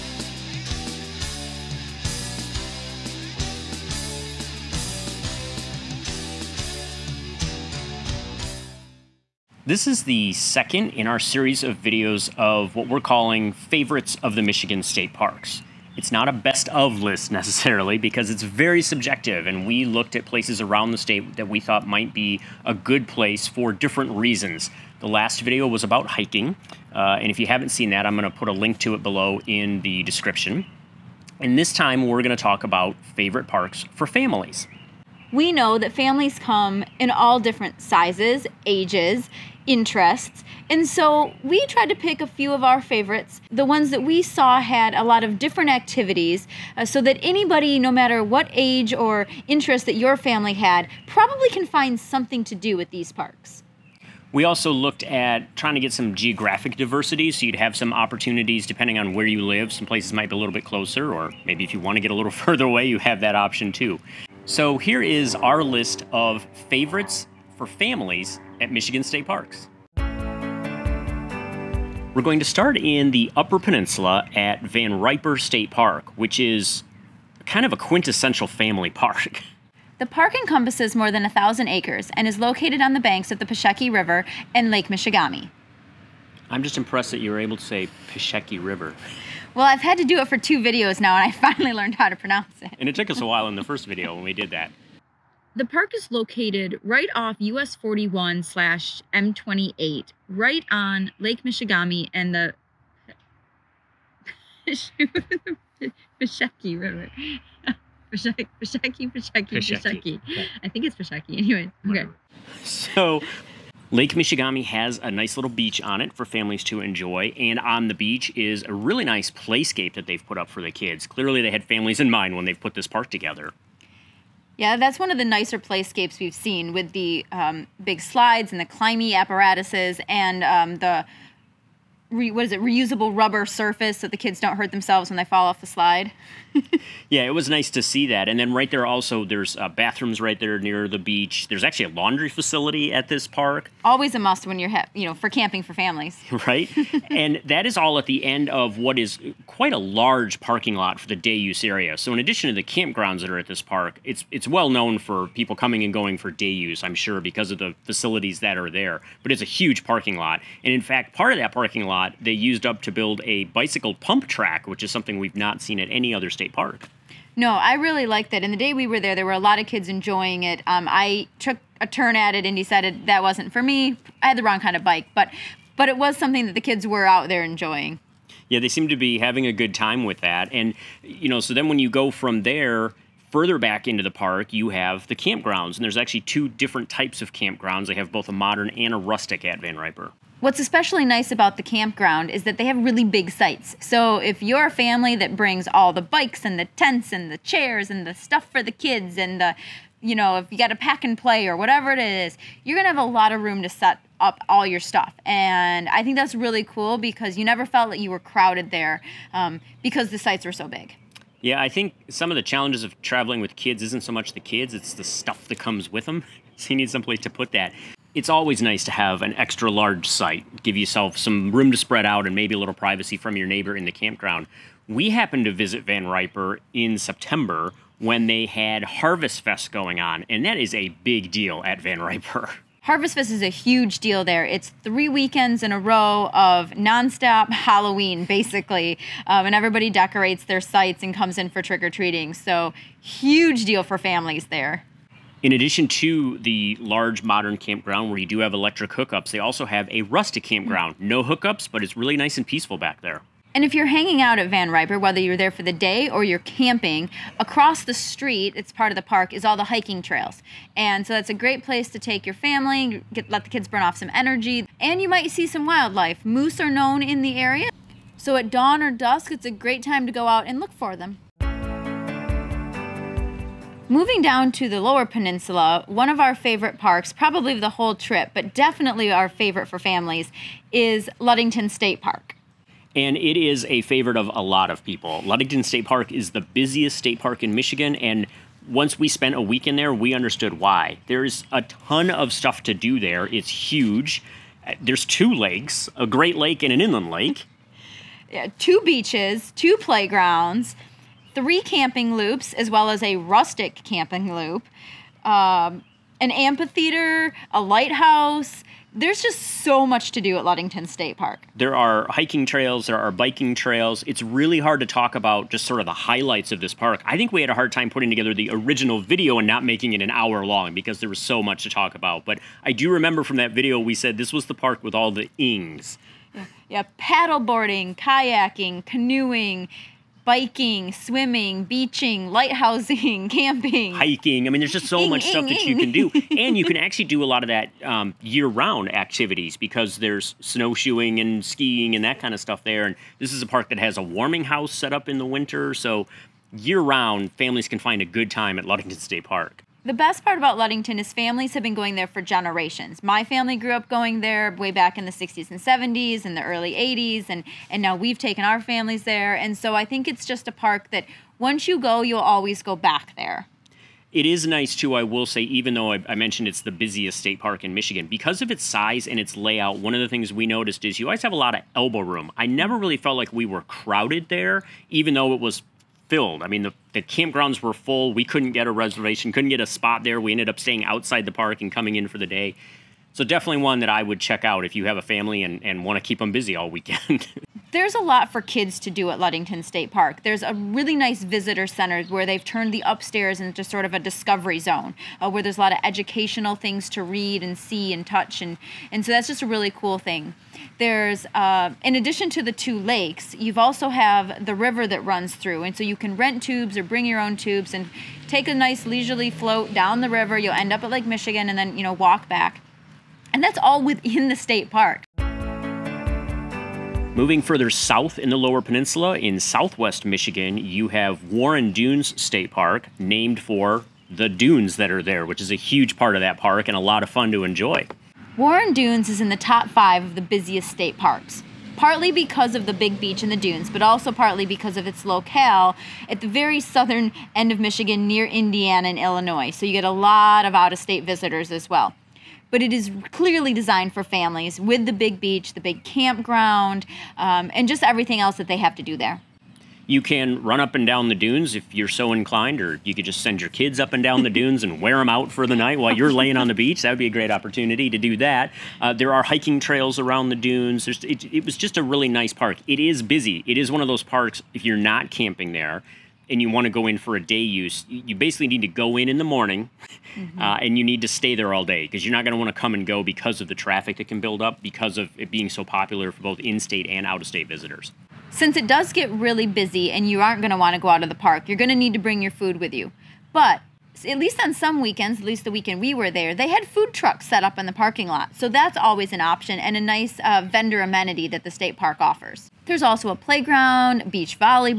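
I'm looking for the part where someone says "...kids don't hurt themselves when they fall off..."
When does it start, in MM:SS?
02:14.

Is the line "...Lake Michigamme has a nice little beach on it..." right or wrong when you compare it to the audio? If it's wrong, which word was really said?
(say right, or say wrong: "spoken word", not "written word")
right.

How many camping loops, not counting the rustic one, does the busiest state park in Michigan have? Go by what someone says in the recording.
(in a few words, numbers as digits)
3.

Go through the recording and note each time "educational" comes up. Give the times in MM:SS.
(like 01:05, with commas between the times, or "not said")
06:35.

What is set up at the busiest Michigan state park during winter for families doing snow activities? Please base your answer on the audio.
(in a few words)
A warming house.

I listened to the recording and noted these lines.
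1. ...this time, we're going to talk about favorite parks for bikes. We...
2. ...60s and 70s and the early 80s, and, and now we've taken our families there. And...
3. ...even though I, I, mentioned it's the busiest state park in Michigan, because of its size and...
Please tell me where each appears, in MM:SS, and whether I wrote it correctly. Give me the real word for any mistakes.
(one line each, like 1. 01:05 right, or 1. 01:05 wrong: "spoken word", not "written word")
1. 00:31 wrong: "families", not "bikes"
2. 05:55 right
3. 06:05 right.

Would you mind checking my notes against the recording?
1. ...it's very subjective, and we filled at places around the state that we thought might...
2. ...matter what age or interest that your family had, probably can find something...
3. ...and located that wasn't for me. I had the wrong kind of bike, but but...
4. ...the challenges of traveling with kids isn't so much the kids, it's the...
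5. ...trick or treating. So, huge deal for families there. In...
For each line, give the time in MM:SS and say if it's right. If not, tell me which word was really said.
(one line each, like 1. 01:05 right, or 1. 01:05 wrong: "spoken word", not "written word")
1. 00:18 wrong: "looked", not "filled"
2. 00:47 right
3. 02:52 wrong: "decided", not "located"
4. 03:32 right
5. 04:01 right.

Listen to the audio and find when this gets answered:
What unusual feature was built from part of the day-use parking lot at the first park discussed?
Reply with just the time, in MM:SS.
02:43.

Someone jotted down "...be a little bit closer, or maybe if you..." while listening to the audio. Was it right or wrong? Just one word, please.
right.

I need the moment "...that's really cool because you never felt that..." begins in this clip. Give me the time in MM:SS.
03:26.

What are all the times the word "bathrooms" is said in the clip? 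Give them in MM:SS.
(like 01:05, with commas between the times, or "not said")
02:19.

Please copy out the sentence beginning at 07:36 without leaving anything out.
That would be a great opportunity to do that.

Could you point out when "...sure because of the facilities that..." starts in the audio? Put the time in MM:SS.
02:36.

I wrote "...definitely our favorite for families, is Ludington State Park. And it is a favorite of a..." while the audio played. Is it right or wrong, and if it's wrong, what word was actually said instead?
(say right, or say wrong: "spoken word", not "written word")
right.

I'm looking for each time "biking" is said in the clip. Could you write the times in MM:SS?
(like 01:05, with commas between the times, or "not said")
05:13, 05:30.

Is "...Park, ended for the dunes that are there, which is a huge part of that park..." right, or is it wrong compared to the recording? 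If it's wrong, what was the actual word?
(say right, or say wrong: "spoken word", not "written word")
wrong: "named", not "ended".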